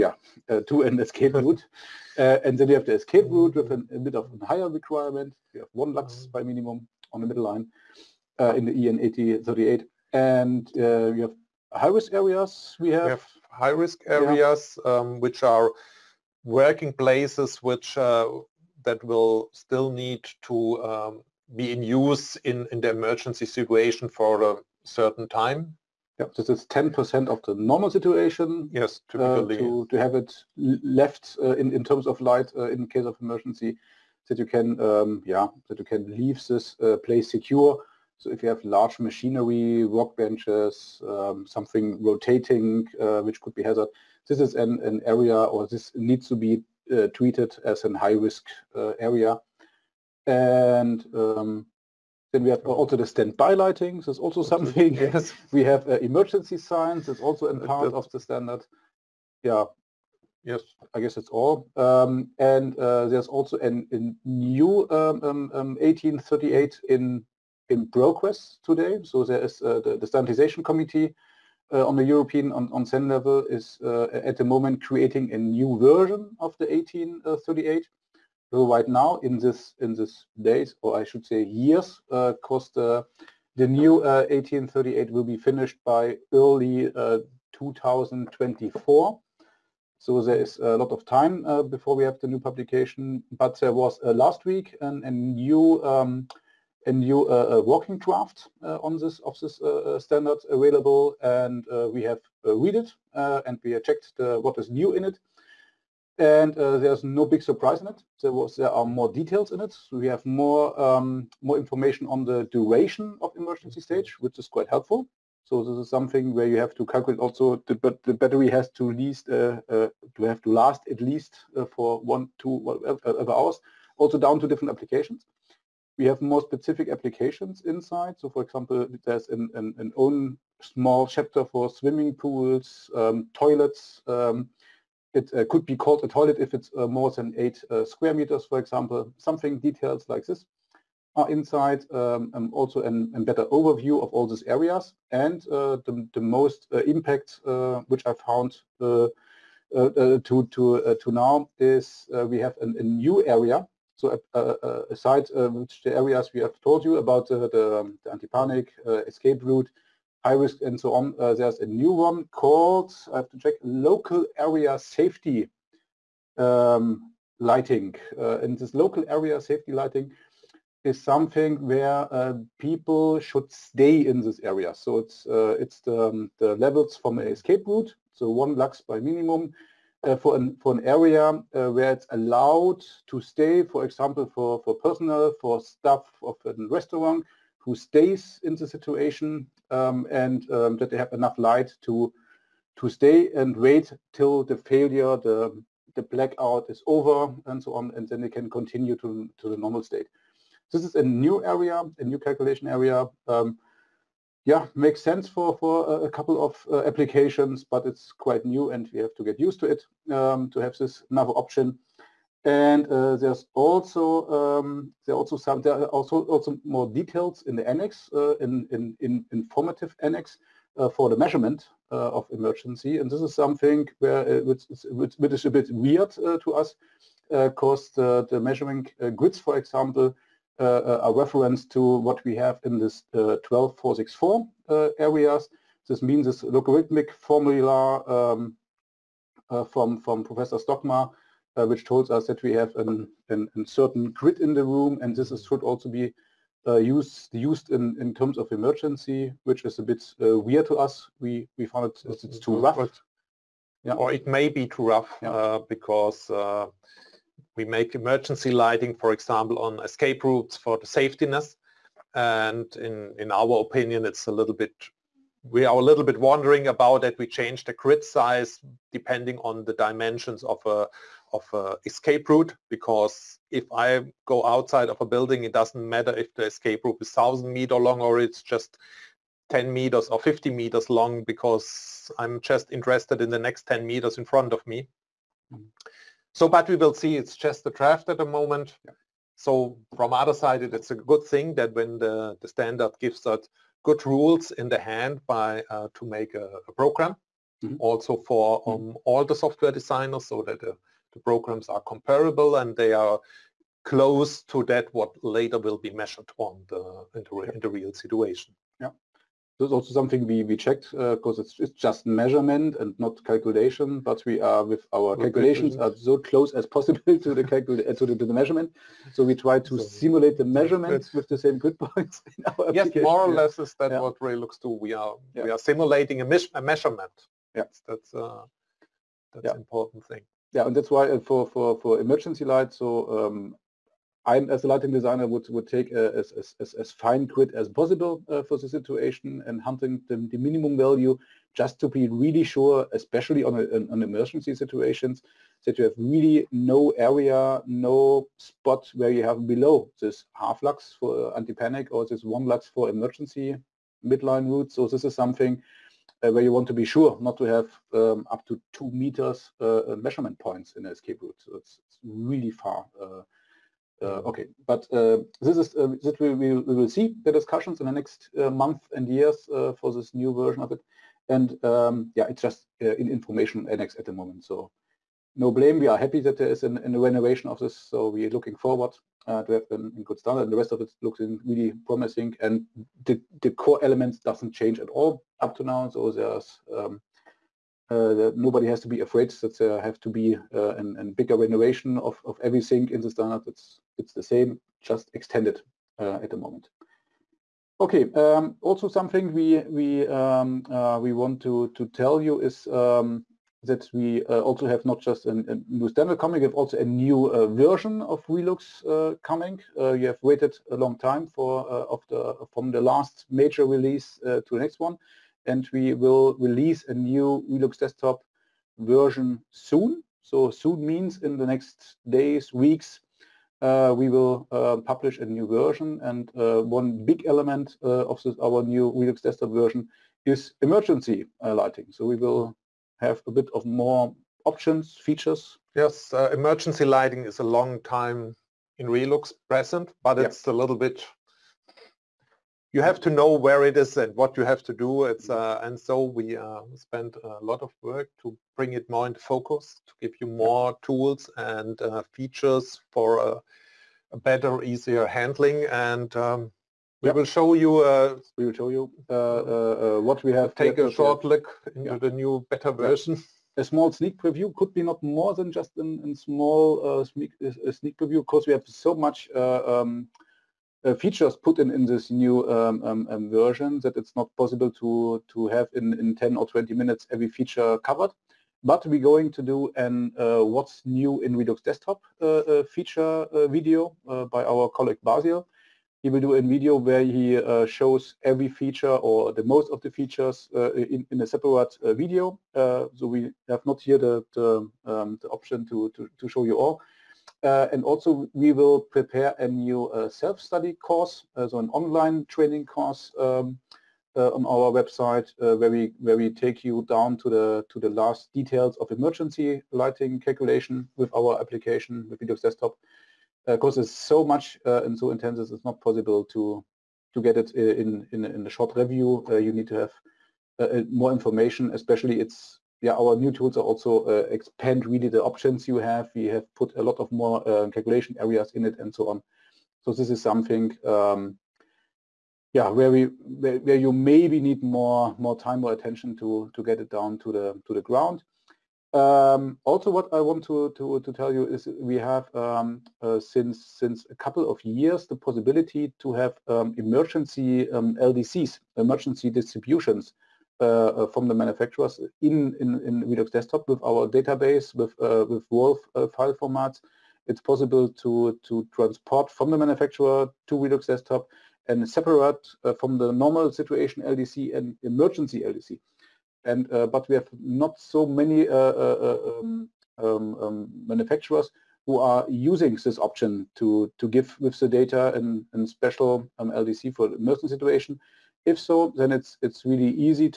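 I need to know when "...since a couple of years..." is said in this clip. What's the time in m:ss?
9:03.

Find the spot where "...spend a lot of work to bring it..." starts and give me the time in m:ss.
7:26.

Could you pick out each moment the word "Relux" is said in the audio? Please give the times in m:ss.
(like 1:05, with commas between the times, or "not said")
6:48, 6:57, 7:08, 7:18, 8:01, 9:13, 9:20.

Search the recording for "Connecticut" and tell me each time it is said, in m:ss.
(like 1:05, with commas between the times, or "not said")
not said.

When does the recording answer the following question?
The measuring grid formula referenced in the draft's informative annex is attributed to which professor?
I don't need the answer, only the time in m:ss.
4:00.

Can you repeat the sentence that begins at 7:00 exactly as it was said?
So soon means in the next days, weeks, we will publish a new version.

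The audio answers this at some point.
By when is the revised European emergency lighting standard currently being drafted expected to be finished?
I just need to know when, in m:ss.
1:26.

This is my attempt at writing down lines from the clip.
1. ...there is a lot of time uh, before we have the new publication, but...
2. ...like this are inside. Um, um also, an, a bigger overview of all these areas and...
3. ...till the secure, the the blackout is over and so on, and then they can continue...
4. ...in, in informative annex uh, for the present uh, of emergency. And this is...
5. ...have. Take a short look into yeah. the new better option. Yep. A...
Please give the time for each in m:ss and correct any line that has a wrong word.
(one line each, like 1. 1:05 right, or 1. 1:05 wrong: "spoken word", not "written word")
1. 1:30 right
2. 2:20 wrong: "better", not "bigger"
3. 3:14 wrong: "failure", not "secure"
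4. 3:38 wrong: "measurement", not "present"
5. 7:40 wrong: "version", not "option".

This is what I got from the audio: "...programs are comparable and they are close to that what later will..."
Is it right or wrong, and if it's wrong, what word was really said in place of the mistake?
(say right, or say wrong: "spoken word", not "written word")
right.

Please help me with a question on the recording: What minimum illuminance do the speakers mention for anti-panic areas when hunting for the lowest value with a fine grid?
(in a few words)
half lux.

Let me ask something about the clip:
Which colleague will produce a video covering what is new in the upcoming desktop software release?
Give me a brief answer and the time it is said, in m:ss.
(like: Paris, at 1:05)
Basil, at 8:05.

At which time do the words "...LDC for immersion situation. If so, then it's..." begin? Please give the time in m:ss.
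9:36.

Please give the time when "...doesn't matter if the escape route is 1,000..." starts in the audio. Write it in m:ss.
4:35.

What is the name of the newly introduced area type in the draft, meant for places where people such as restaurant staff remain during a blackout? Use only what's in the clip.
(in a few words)
local area safety lighting.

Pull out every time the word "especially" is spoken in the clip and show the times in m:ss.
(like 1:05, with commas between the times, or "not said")
5:42, 8:41.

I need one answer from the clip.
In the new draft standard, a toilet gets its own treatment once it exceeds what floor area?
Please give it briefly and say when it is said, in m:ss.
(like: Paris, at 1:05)
8 square meters, at 2:16.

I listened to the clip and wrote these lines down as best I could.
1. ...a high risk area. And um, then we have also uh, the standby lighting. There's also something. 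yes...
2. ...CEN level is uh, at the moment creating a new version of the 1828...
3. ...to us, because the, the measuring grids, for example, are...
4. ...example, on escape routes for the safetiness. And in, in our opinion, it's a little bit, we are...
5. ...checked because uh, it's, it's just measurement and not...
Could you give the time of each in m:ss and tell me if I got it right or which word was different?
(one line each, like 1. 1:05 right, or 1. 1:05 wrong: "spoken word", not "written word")
1. 0:47 right
2. 1:12 wrong: "1838", not "1828"
3. 3:46 right
4. 4:19 right
5. 5:10 right.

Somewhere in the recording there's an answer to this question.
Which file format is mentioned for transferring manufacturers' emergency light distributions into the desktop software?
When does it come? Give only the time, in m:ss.
9:15.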